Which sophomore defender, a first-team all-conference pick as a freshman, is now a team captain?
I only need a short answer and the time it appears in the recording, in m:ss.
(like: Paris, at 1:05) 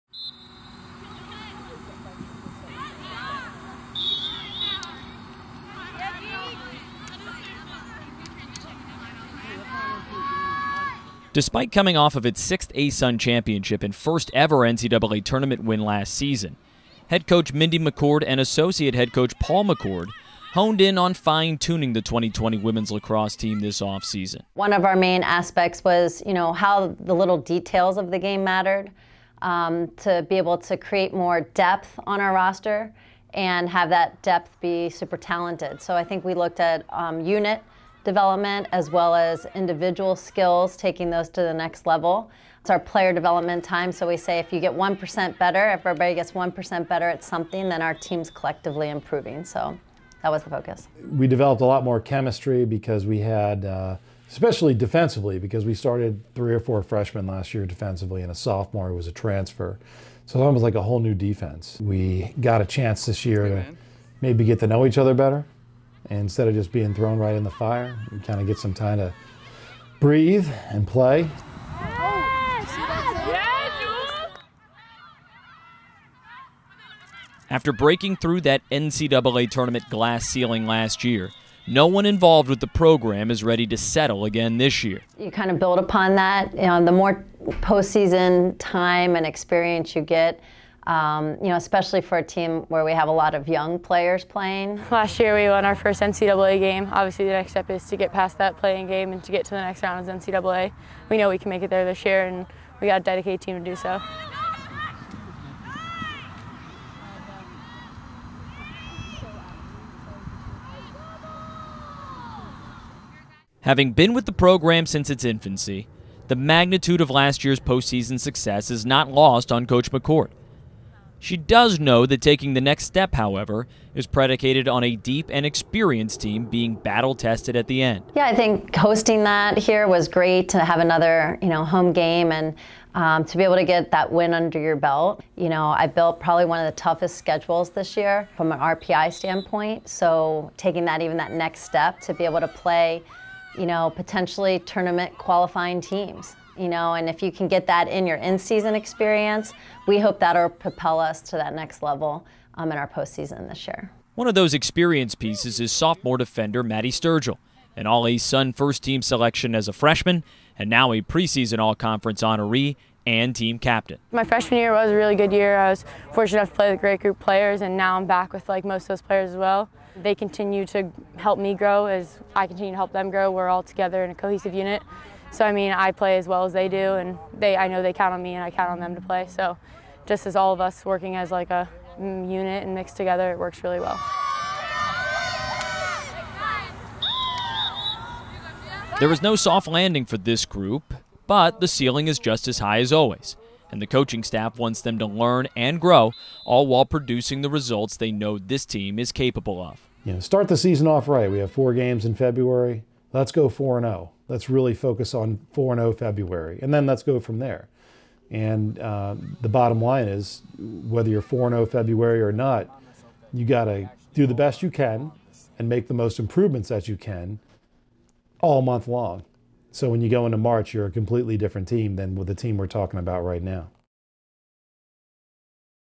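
Maddie Sturgill, at 2:36.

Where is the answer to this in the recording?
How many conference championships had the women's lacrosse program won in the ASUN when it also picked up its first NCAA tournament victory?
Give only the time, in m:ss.
0:12.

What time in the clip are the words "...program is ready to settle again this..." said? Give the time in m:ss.
1:22.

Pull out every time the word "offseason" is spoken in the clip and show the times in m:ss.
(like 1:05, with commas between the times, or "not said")
0:23.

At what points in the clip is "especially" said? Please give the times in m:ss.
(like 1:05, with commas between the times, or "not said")
0:54, 1:31.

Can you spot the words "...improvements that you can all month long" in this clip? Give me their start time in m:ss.
3:36.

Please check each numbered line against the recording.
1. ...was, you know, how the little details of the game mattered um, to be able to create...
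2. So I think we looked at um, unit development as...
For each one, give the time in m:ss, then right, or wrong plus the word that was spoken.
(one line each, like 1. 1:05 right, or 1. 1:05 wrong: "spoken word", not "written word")
1. 0:25 right
2. 0:35 right.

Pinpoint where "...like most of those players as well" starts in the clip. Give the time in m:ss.
2:48.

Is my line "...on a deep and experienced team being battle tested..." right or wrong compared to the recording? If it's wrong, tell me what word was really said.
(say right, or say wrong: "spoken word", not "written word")
right.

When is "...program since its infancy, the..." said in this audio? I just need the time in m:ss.
1:54.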